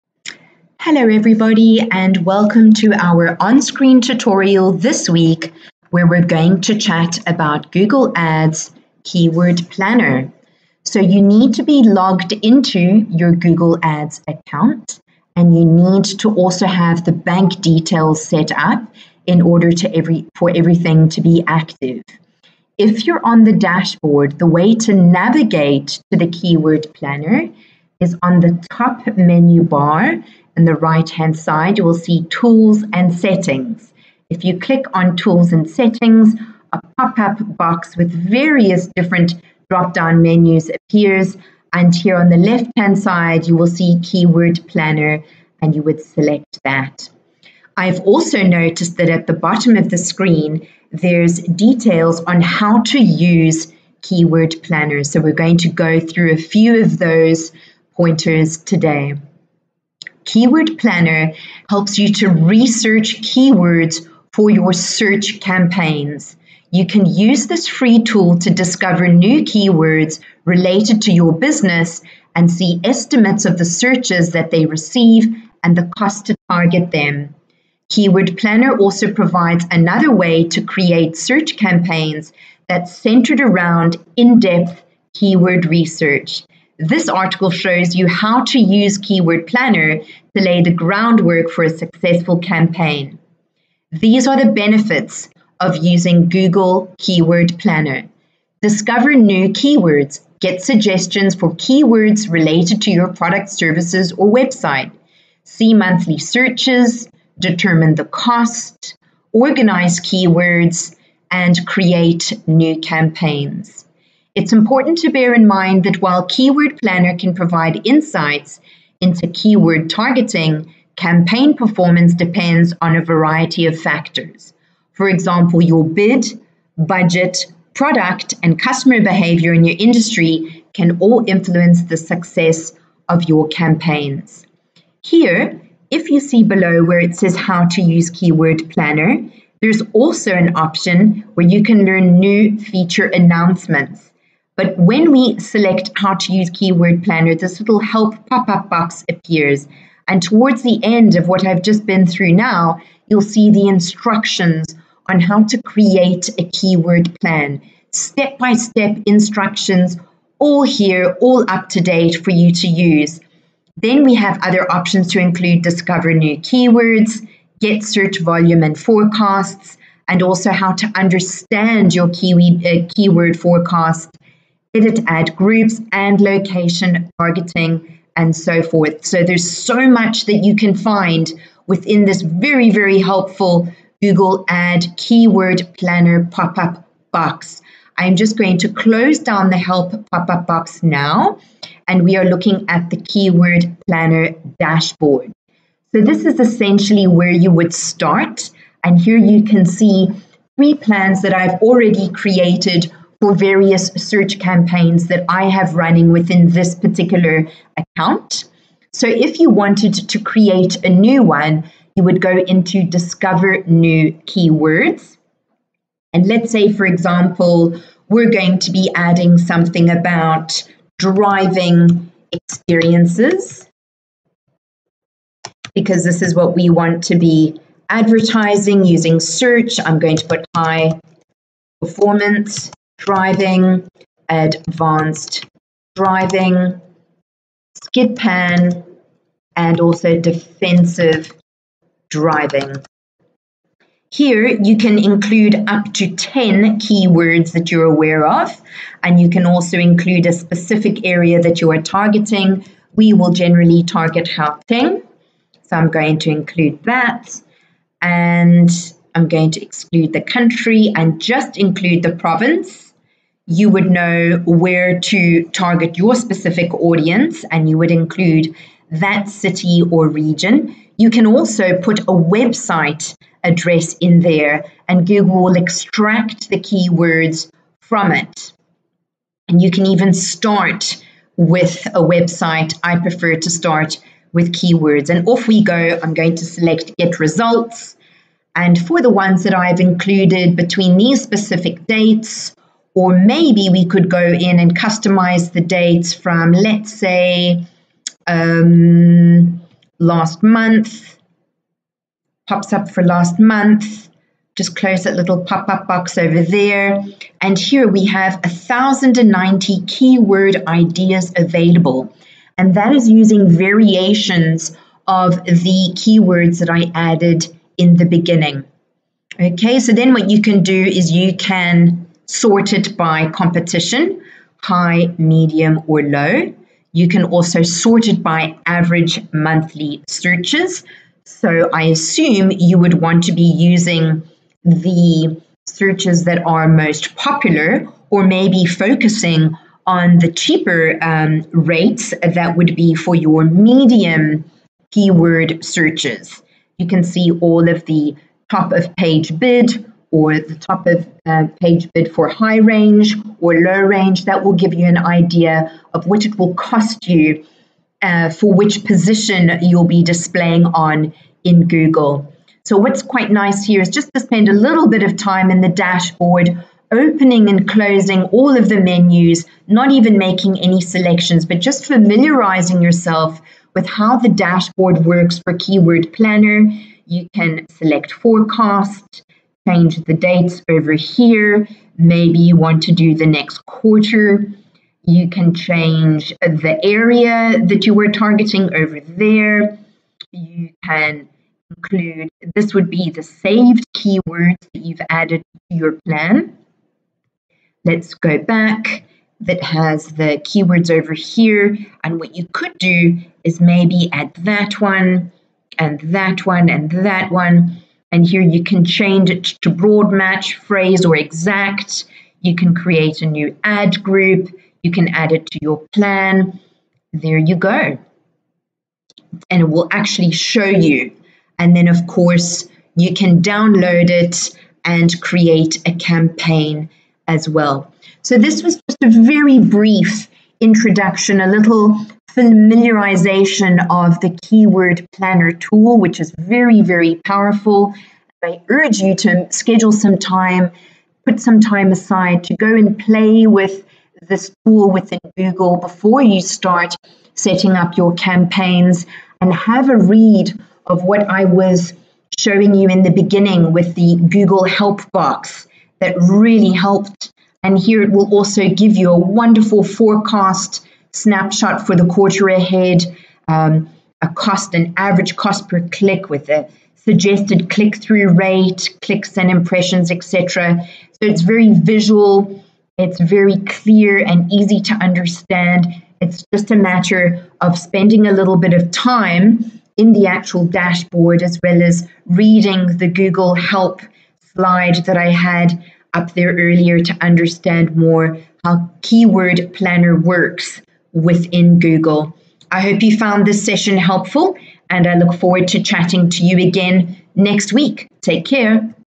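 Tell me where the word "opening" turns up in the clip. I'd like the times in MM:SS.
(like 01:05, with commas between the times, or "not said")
06:06.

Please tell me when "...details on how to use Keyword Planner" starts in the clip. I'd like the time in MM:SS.
00:51.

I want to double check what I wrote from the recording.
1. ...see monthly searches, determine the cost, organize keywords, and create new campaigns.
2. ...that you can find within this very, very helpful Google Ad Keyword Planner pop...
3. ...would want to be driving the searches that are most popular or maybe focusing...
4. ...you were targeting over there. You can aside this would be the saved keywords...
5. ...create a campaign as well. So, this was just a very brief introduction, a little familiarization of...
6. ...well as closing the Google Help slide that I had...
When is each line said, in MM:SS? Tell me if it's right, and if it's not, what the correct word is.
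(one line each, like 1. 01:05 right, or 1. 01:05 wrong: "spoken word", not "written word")
1. 01:45 right
2. 03:00 right
3. 05:32 wrong: "using", not "driving"
4. 06:27 wrong: "include", not "aside"
5. 07:05 right
6. 08:01 wrong: "reading", not "closing".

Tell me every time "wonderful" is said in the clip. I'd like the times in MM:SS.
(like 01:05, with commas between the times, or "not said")
07:39.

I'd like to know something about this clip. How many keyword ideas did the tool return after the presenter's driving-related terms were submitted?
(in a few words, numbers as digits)
1,090.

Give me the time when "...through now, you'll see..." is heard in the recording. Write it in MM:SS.
02:32.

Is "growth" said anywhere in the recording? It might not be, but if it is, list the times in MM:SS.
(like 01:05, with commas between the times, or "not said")
not said.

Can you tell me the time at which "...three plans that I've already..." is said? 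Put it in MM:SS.
03:20.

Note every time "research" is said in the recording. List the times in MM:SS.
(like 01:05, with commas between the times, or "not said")
01:02, 01:25.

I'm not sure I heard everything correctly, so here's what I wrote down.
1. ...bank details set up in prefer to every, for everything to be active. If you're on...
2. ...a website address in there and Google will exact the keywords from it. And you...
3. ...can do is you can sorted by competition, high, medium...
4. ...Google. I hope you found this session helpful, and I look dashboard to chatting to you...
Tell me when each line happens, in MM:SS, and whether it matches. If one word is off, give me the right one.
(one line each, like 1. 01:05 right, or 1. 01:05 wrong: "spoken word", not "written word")
1. 00:17 wrong: "order", not "prefer"
2. 04:32 wrong: "extract", not "exact"
3. 05:20 right
4. 08:11 wrong: "forward", not "dashboard".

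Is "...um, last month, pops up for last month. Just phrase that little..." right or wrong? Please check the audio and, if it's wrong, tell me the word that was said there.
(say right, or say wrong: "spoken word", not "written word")
wrong: "close", not "phrase".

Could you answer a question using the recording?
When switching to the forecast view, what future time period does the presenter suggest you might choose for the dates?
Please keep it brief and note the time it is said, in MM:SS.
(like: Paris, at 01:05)
the next quarter, at 06:23.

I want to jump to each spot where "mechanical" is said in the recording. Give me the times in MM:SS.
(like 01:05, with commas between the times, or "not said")
not said.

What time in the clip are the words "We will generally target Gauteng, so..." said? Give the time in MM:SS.
04:12.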